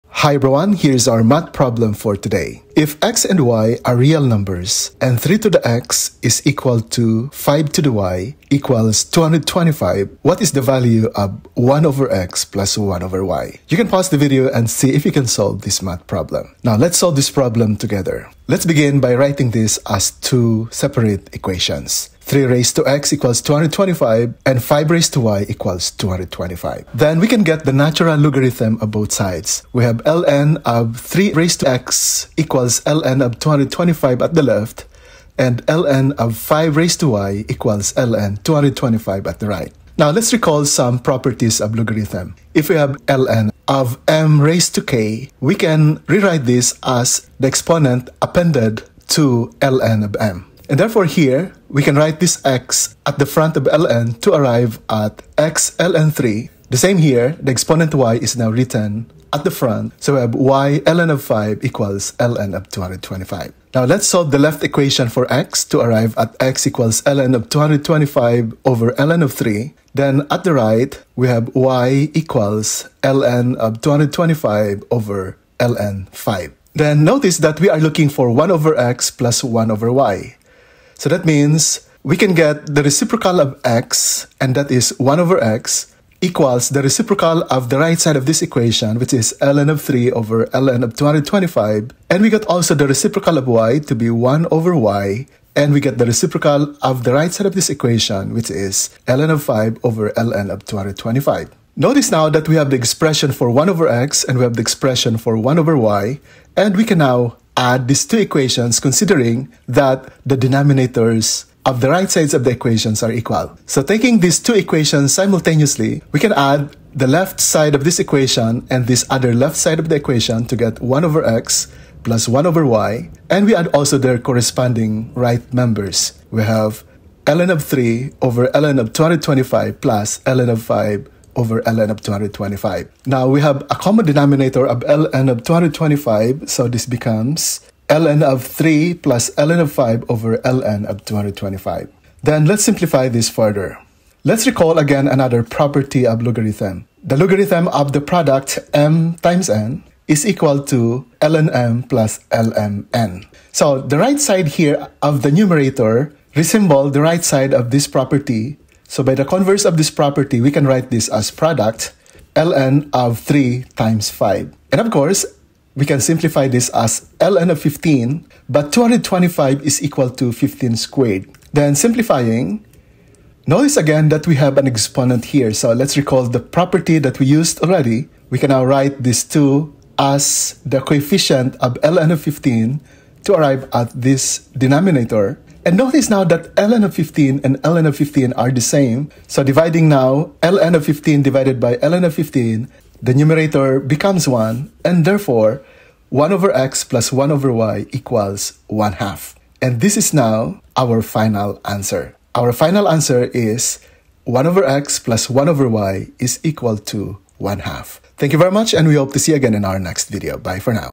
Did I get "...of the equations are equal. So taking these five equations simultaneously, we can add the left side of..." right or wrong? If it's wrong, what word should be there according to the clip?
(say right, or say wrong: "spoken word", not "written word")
wrong: "two", not "five".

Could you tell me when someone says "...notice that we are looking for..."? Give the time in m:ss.
1:17.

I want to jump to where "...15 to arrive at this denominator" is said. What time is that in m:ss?
3:02.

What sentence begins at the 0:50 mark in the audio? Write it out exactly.
And therefore here, we can write this x at the front of ln to arrive at x ln3.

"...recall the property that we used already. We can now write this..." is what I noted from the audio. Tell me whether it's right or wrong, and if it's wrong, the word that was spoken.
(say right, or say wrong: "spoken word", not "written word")
right.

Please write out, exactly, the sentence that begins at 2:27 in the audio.
The logarithm of the product m times n is equal to ln m plus ln n.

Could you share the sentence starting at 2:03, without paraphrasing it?
And we add also their corresponding right members.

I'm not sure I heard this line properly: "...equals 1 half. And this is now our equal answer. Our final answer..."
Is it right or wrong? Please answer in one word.
wrong.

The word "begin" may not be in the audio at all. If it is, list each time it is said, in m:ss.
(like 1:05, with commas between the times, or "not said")
0:18.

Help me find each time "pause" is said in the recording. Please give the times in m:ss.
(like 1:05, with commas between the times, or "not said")
0:13.